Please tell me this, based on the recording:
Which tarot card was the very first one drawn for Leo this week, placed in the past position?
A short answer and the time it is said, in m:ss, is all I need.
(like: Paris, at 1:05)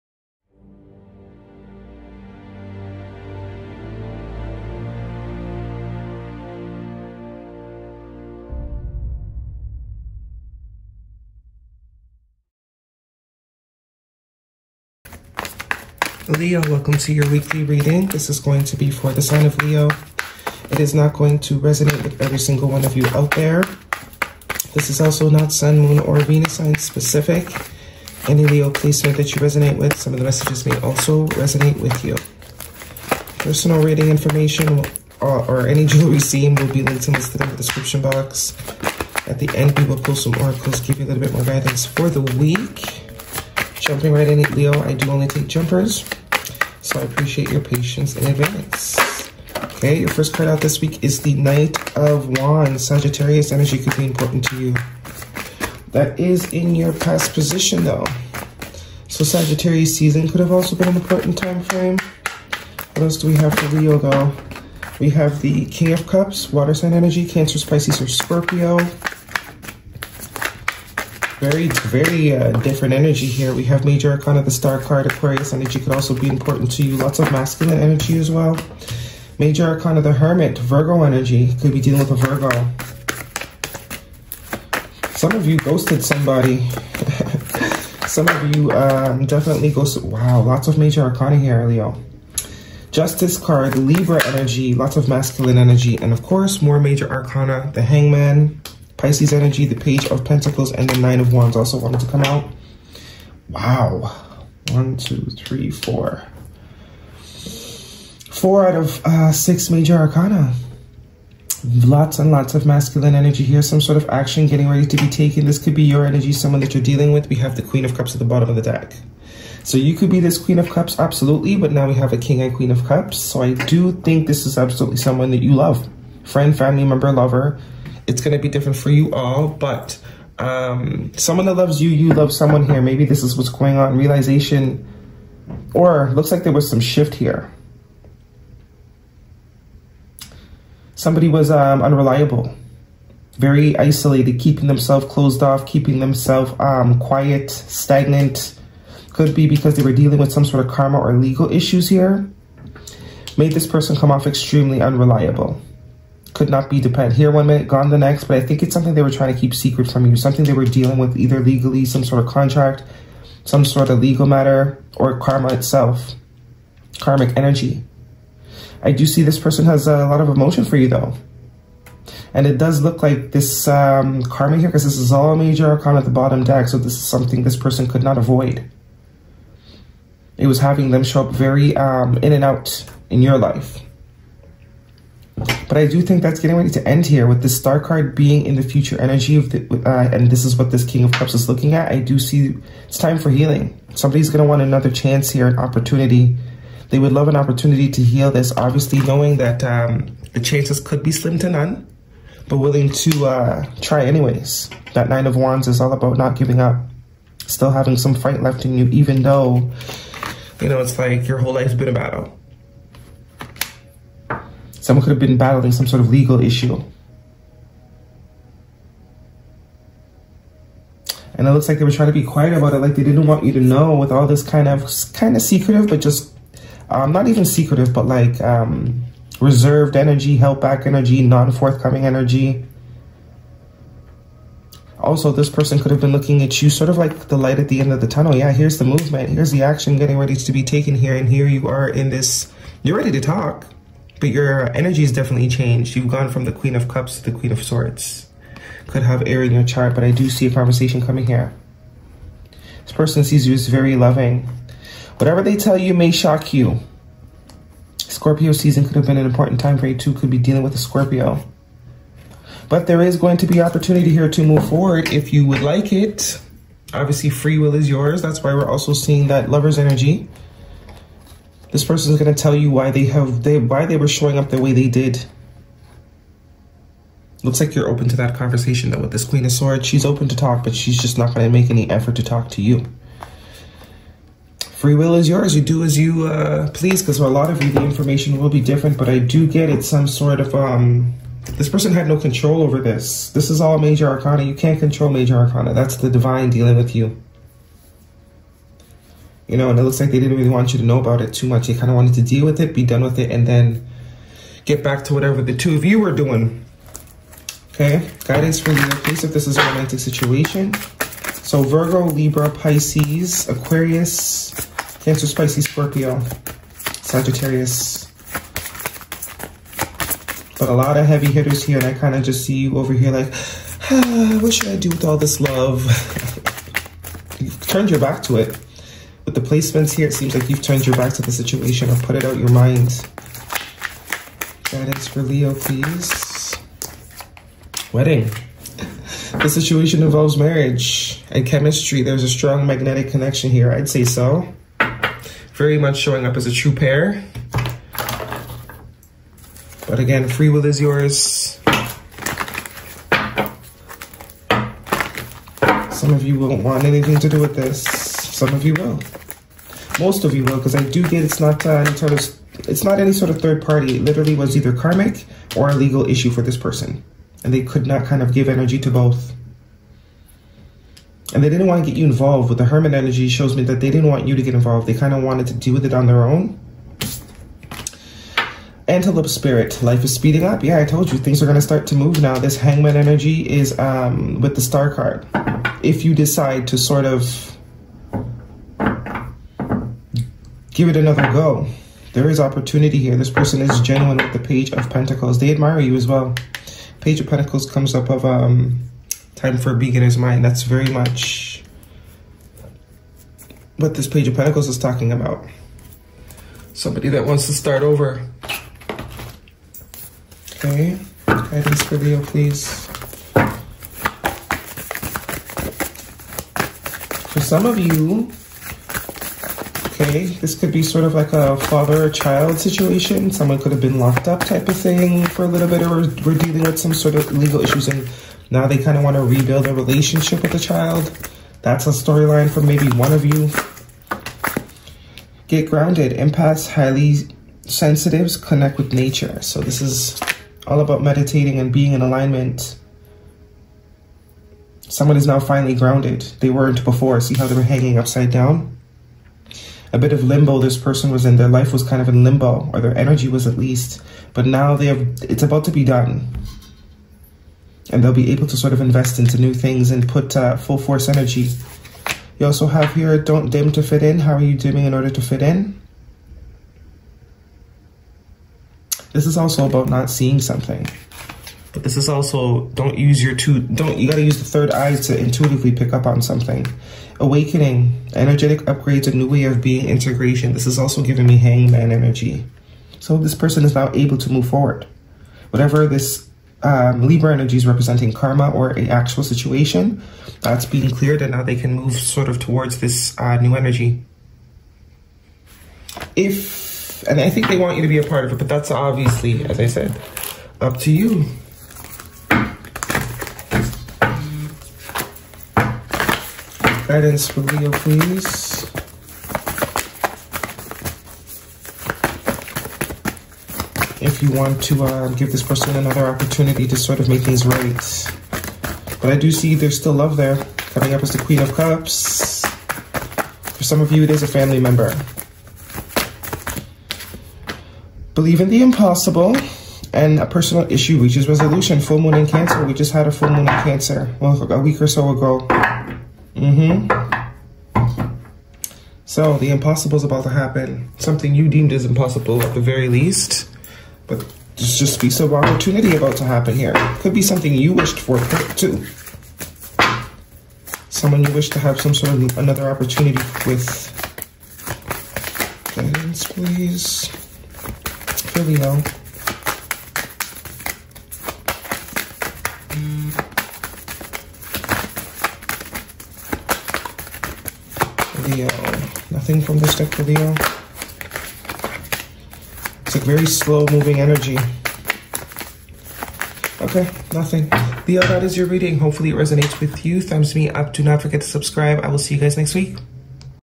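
Knight of Wands, at 0:51.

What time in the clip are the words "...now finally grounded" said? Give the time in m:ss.
7:25.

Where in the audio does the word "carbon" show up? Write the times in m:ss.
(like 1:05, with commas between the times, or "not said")
not said.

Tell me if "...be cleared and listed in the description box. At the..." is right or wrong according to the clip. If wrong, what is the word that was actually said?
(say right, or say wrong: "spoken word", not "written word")
wrong: "linked", not "cleared".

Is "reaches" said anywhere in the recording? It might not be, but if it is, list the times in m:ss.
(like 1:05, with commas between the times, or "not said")
8:50.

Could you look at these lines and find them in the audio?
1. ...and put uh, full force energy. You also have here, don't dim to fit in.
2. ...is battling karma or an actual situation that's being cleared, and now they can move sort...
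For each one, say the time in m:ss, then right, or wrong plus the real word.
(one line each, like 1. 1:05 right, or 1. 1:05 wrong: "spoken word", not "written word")
1. 7:39 right
2. 8:07 wrong: "representing", not "battling".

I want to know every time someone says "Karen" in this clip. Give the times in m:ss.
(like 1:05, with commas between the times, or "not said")
not said.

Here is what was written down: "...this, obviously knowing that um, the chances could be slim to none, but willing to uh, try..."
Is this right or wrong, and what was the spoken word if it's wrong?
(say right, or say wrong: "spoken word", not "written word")
right.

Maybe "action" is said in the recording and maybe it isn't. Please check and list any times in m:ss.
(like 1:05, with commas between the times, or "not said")
1:54, 3:59.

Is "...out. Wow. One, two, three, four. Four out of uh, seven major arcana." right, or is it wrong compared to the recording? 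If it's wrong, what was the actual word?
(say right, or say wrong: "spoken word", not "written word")
wrong: "six", not "seven".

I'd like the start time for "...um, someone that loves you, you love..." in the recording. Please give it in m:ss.
2:10.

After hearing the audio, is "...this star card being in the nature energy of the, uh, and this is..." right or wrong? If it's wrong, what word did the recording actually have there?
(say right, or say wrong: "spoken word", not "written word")
wrong: "future", not "nature".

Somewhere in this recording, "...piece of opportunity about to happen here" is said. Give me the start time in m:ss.
9:04.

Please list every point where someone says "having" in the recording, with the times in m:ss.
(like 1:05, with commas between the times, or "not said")
3:00, 3:27.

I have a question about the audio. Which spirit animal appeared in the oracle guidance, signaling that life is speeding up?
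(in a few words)
Antelope.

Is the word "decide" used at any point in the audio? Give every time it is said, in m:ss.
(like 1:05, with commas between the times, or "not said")
6:26.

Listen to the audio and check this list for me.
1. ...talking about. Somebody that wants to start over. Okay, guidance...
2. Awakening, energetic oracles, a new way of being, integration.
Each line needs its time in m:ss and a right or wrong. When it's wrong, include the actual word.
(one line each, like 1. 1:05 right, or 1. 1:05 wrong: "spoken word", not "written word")
1. 6:44 right
2. 7:57 wrong: "upgrades", not "oracles".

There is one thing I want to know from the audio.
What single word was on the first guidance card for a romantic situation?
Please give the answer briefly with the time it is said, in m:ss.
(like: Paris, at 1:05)
Wedding, at 5:37.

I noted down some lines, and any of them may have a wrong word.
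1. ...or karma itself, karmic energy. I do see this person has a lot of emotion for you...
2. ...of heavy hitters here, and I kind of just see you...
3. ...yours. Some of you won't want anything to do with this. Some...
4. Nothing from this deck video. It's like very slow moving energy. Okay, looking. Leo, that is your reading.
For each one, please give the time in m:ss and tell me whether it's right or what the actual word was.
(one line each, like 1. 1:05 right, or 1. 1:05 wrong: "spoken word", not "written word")
1. 2:44 right
2. 5:20 right
3. 5:50 right
4. 9:29 wrong: "nothing", not "looking".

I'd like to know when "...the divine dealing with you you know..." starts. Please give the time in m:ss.
4:55.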